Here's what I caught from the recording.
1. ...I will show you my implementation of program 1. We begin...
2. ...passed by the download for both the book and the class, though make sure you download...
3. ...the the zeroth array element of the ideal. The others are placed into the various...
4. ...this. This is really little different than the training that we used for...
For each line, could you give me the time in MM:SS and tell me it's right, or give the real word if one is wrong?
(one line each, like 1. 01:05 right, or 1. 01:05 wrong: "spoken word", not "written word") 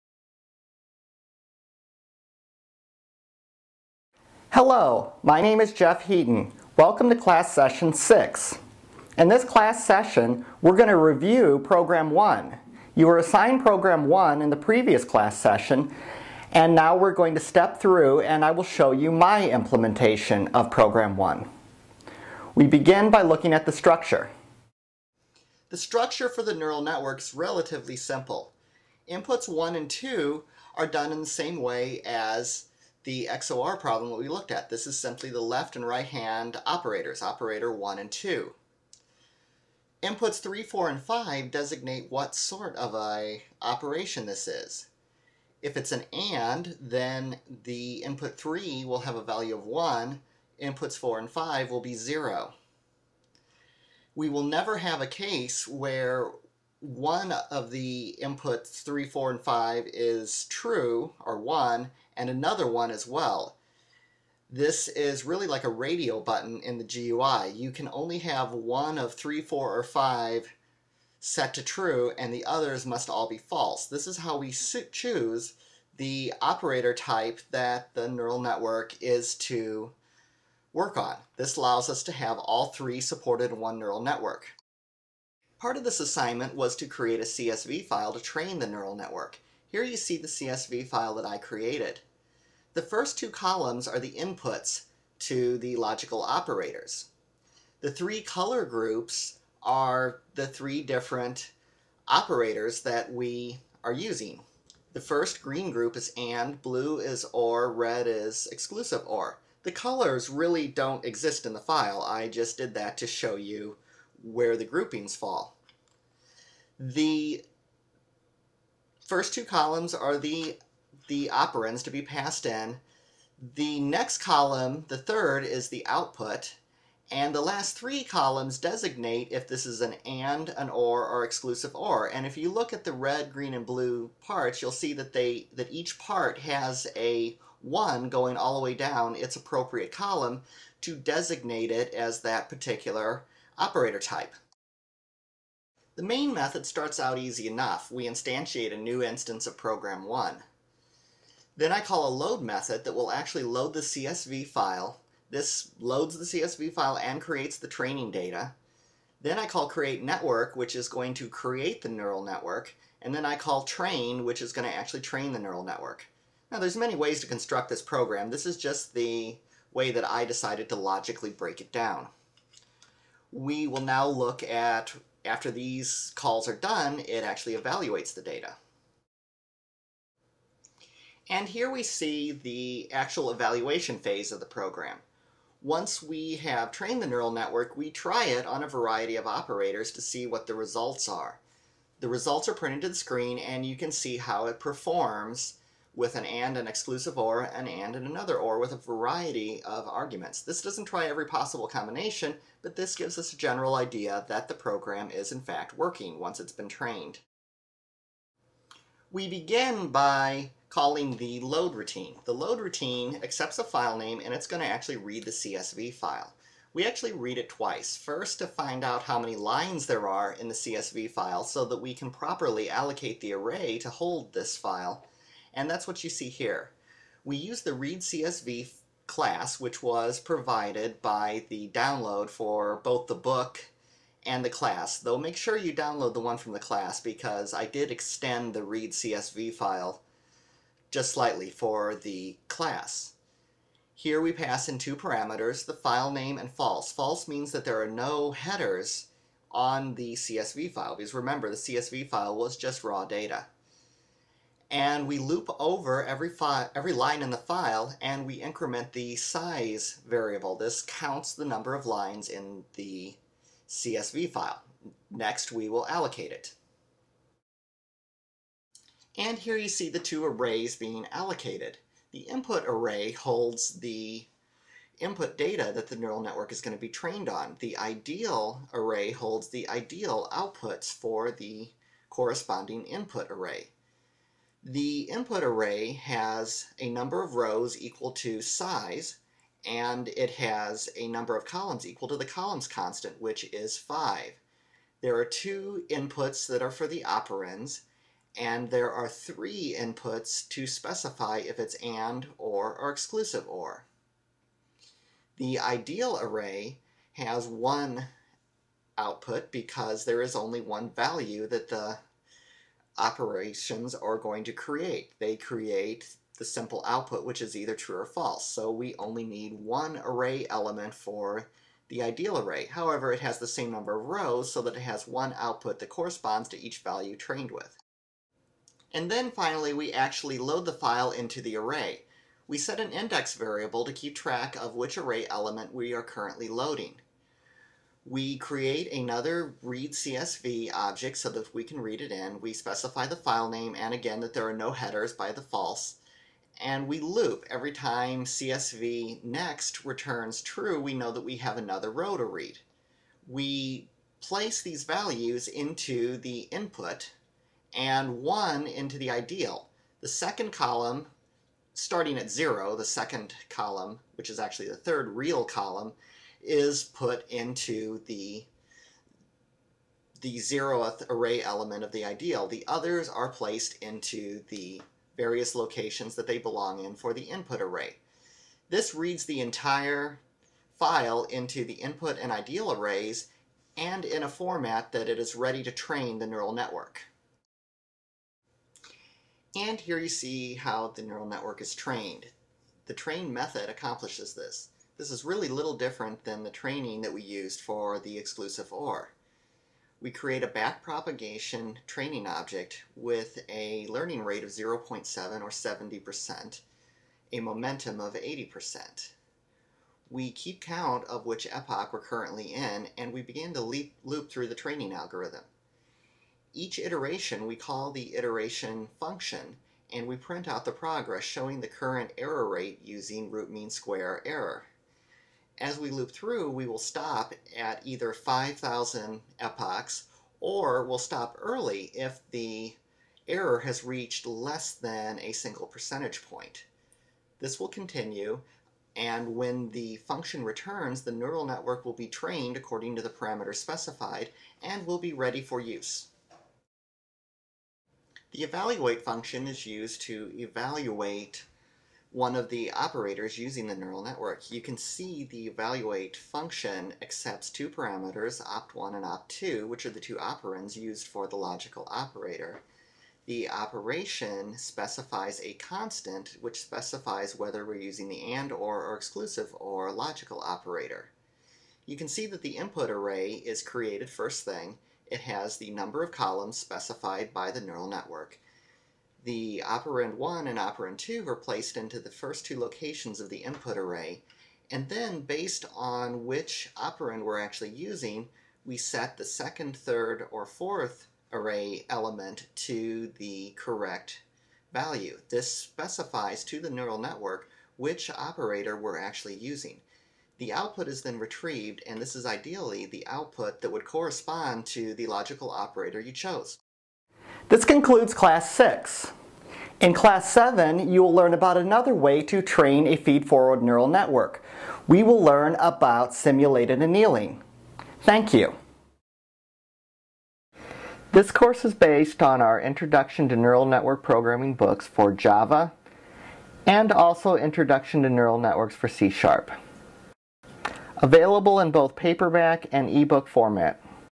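1. 00:18 right
2. 03:50 wrong: "provided", not "passed"
3. 06:08 right
4. 06:34 right.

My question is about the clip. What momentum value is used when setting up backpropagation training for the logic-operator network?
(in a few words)
80%.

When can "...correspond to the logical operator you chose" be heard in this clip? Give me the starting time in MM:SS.
08:23.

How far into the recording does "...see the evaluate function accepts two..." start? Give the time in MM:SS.
07:34.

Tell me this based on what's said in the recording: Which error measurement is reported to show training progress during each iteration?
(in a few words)
Root mean square error.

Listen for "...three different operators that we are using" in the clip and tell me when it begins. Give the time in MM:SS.
01:40.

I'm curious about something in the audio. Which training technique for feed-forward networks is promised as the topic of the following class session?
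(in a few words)
Simulated annealing.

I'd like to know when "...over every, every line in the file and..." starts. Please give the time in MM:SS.
04:15.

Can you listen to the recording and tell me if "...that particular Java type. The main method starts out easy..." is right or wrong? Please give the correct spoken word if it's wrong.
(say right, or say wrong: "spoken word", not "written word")
wrong: "Operator", not "Java".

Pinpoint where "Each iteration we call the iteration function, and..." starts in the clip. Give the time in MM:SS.
06:56.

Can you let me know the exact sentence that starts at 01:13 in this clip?
This is how we choose the operator type that the neural network is to work on.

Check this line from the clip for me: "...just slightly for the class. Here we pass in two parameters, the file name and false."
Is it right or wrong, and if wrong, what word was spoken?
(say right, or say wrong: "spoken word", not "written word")
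right.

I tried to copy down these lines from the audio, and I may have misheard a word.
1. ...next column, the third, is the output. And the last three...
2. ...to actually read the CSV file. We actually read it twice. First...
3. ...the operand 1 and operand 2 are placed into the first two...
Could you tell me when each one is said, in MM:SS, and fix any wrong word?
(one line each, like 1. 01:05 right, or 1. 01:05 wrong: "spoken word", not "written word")
1. 02:03 right
2. 03:34 right
3. 07:59 right.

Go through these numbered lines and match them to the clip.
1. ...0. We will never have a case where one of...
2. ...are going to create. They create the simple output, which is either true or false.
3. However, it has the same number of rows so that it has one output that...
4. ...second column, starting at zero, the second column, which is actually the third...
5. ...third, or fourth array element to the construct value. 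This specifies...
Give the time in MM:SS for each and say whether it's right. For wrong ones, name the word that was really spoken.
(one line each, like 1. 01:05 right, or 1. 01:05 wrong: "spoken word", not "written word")
1. 00:51 right
2. 05:13 right
3. 05:22 right
4. 06:00 right
5. 08:09 wrong: "correct", not "construct".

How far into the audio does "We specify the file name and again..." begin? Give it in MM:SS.
05:42.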